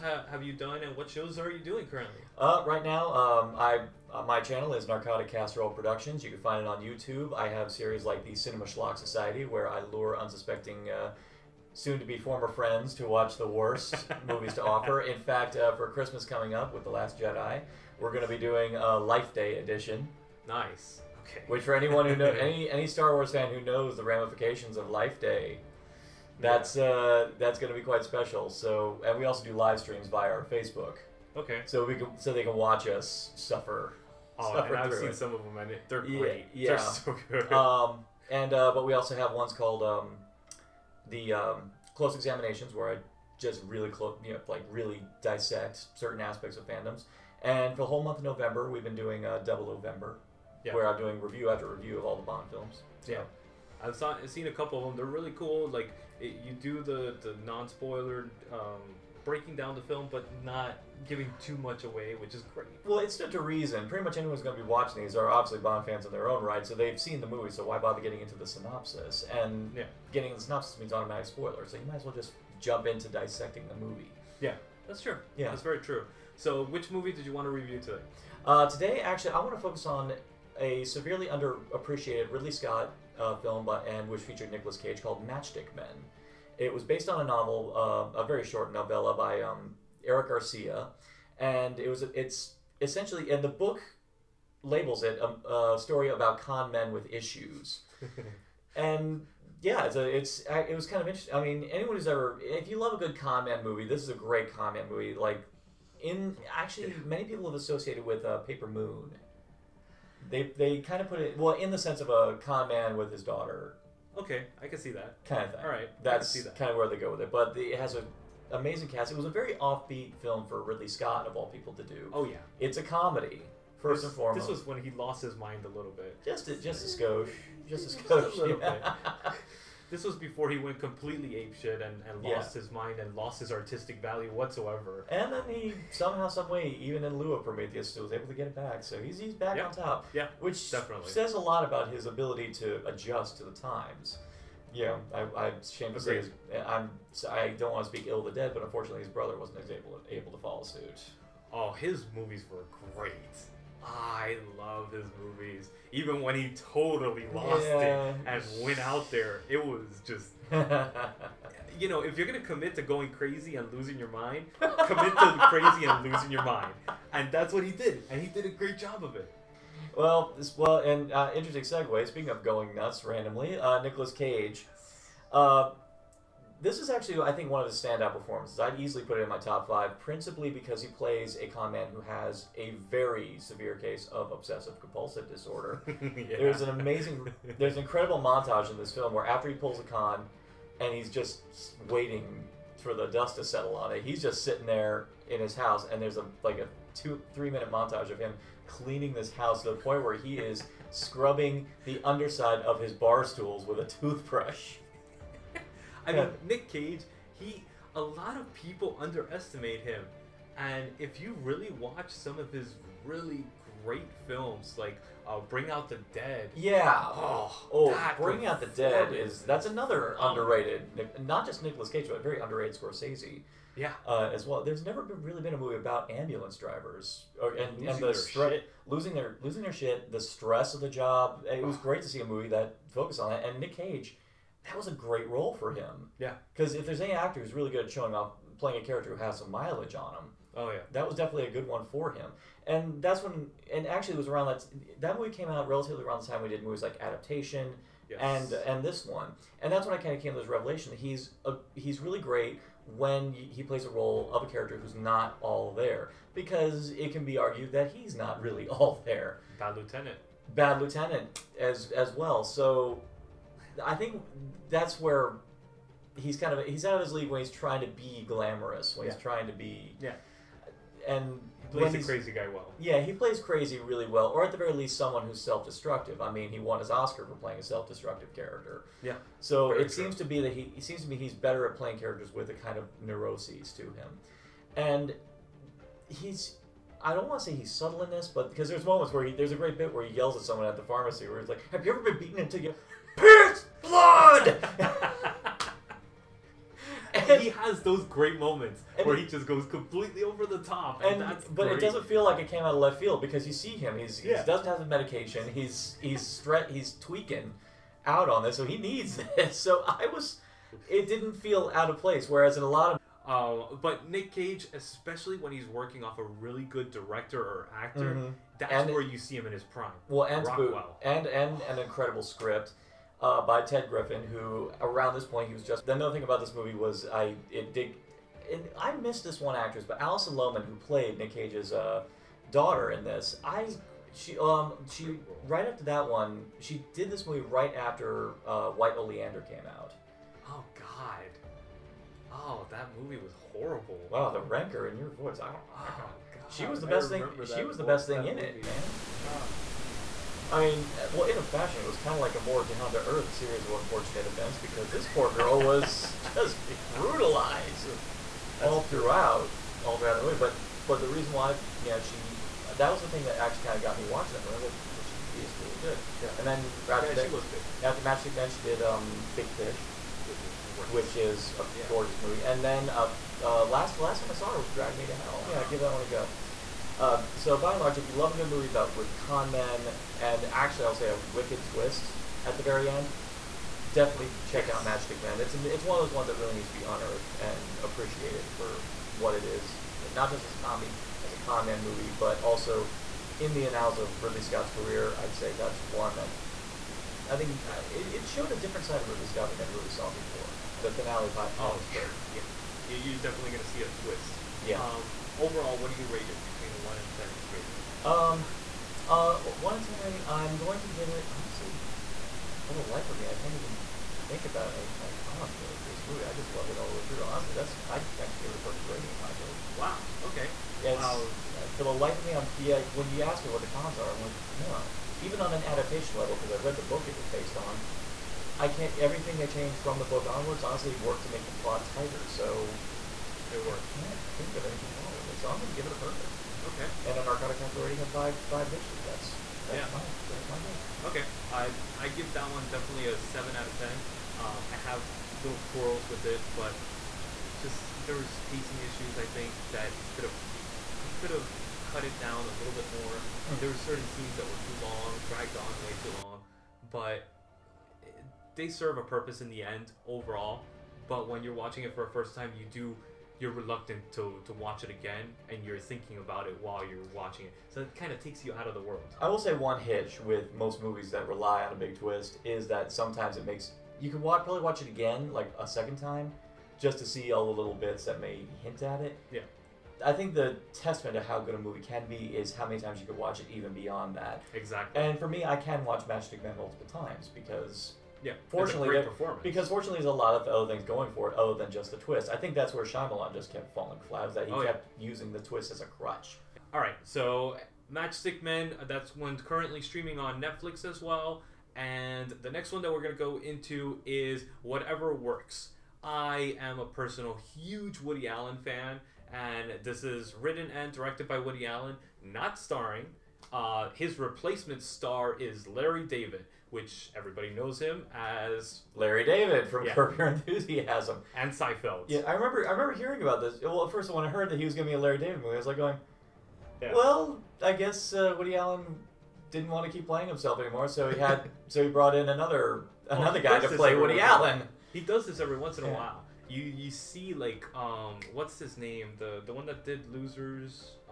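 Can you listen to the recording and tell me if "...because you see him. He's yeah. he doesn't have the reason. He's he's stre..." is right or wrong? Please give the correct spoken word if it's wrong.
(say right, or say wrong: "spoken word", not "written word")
wrong: "medication", not "reason".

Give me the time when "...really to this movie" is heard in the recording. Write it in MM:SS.
06:55.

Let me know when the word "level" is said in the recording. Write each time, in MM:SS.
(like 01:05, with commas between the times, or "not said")
07:06.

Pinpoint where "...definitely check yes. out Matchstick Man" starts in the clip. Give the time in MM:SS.
06:23.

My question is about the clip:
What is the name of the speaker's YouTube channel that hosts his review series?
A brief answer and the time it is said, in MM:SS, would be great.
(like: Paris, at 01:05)
Narcotic Casserole Productions, at 00:04.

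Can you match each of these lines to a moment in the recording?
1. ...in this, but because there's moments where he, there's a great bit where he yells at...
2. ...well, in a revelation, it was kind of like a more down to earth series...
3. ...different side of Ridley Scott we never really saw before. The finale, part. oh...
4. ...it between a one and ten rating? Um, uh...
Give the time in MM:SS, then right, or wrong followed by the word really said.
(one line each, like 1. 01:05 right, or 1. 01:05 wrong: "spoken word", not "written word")
1. 04:48 right
2. 05:51 wrong: "fashion", not "revelation"
3. 06:38 right
4. 06:46 right.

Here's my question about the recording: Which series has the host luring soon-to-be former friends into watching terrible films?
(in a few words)
Cinema Schlock Society.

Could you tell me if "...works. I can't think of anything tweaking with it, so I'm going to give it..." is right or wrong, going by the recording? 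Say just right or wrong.
wrong.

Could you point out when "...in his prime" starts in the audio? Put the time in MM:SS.
05:19.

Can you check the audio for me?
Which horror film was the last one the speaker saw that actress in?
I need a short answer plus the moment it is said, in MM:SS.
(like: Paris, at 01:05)
Drag Me to Hell, at 06:14.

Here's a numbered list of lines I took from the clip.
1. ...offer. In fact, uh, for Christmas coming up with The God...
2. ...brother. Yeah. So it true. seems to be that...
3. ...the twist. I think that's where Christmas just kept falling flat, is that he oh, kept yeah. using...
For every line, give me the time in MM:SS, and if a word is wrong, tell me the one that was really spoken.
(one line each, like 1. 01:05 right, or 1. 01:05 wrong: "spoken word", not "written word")
1. 00:14 wrong: "Last", not "God"
2. 04:38 wrong: "character", not "brother"
3. 08:11 wrong: "Shyamalan", not "Christmas".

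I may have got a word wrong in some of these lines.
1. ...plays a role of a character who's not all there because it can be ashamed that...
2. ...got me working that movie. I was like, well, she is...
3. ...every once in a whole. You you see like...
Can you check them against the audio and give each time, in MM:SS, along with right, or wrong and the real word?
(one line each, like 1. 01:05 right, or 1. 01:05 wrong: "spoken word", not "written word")
1. 04:13 wrong: "argued", not "ashamed"
2. 06:03 wrong: "watching", not "working"
3. 08:55 wrong: "while", not "whole".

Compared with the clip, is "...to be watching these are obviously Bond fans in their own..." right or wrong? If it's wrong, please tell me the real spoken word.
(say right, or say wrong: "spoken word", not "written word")
right.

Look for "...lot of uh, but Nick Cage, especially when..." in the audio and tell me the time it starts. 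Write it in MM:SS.
05:12.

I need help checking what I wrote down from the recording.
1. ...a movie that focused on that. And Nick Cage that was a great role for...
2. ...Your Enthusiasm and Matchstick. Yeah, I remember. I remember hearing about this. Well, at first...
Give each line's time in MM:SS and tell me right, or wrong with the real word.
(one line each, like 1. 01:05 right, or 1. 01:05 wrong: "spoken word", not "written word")
1. 03:52 right
2. 08:40 wrong: "Seinfeld", not "Matchstick".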